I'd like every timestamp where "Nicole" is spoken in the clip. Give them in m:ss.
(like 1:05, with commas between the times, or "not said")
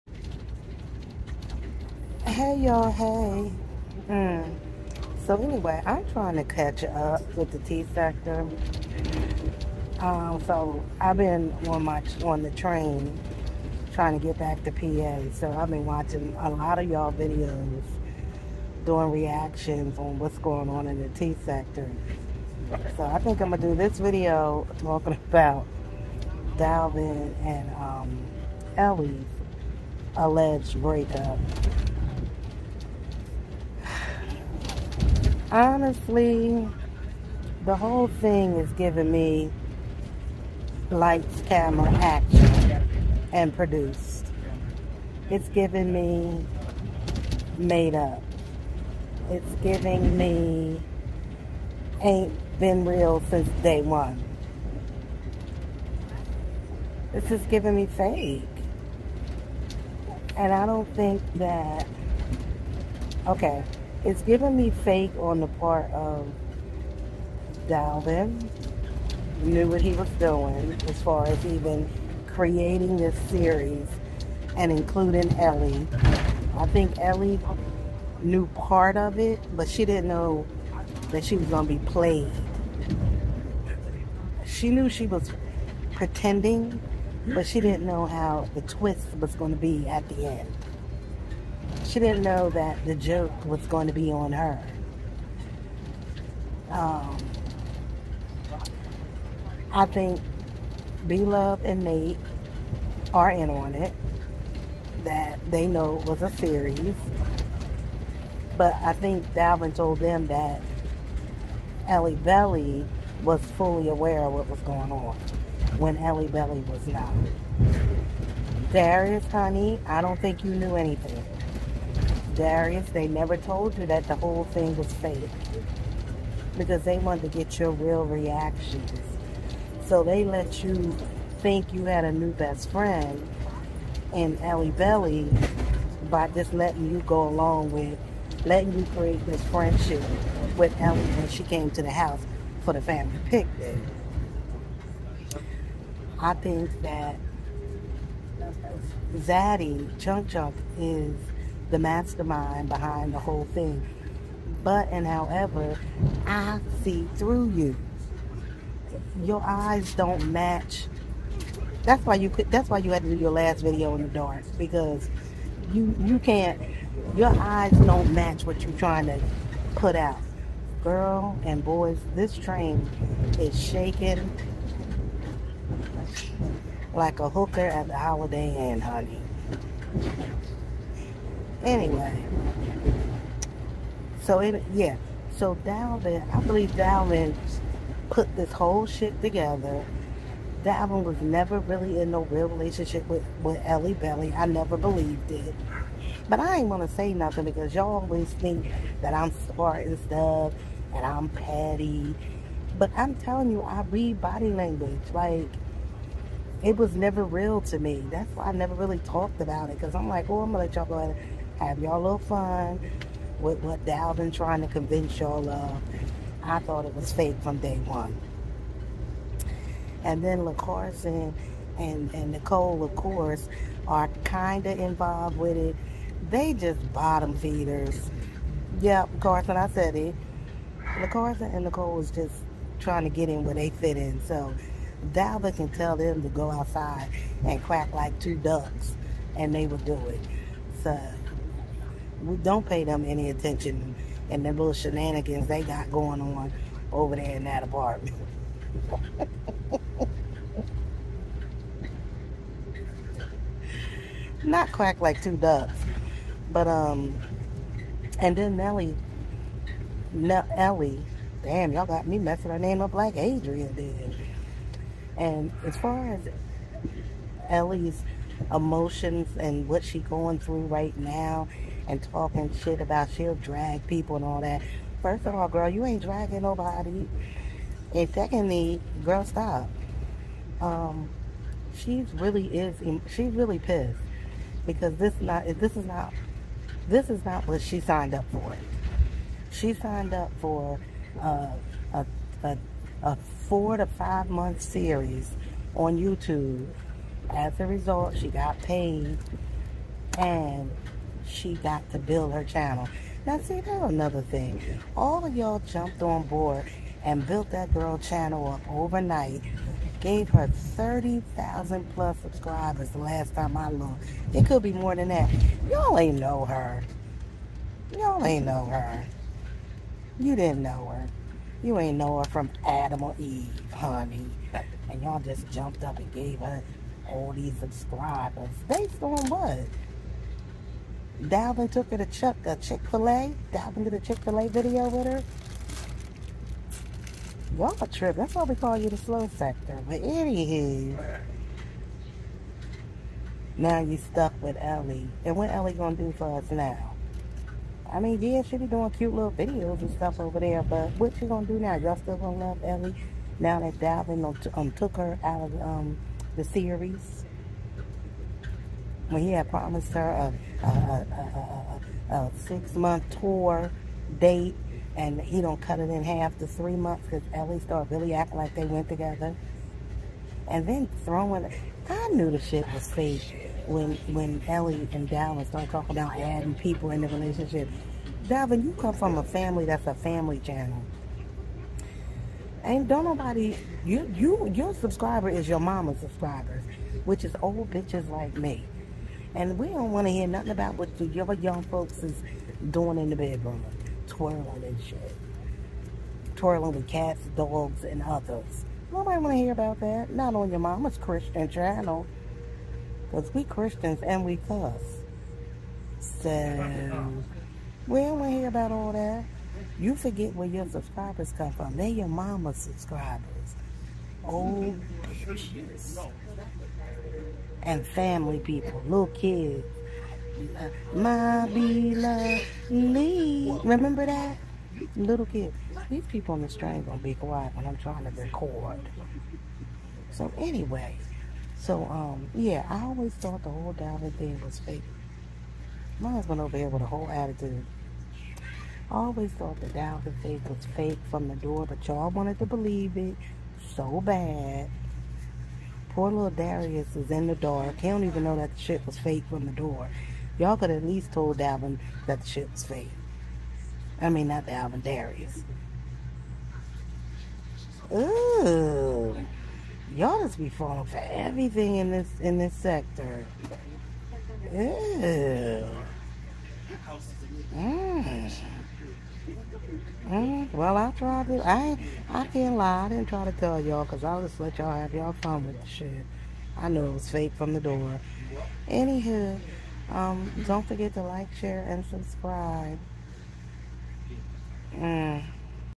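3:42, 3:51.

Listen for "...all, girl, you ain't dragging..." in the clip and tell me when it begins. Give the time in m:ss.
4:35.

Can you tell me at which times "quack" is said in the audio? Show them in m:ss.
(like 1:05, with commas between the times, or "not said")
3:57, 4:14.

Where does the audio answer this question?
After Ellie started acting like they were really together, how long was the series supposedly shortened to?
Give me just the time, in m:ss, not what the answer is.
6:06.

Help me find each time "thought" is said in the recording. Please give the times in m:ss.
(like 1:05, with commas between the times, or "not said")
3:36, 7:13, 7:19.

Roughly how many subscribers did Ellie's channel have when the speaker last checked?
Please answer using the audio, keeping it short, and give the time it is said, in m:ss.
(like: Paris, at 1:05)
30,000, at 5:10.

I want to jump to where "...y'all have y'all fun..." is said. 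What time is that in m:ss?
7:54.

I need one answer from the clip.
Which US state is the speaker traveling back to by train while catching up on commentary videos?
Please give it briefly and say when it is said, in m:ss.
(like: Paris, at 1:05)
PA, at 0:14.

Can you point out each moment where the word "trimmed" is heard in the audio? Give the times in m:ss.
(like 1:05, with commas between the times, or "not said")
not said.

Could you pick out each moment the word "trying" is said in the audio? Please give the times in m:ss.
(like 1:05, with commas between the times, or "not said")
0:06, 0:13, 2:48, 3:34, 3:52, 7:07.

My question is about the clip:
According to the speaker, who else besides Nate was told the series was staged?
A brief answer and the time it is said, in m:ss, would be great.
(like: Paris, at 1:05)
B Love, at 1:41.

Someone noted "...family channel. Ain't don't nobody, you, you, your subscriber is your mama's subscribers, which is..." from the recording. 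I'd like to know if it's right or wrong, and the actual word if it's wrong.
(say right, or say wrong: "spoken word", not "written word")
right.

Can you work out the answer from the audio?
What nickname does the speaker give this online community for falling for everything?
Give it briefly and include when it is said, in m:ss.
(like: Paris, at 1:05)
the slow sector, at 5:38.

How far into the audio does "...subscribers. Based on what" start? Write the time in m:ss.
5:27.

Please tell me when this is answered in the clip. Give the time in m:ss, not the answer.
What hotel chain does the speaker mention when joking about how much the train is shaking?
2:57.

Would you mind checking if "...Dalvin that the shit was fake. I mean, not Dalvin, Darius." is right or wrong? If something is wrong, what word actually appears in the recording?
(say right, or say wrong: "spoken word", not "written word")
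right.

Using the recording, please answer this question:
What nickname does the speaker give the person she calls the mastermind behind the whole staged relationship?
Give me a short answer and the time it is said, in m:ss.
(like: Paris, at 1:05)
Zaddy Chunk Chunk, at 2:29.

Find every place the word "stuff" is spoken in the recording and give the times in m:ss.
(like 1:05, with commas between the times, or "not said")
3:19, 5:49.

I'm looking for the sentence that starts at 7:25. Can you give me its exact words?
Poor little Darius is in the dark.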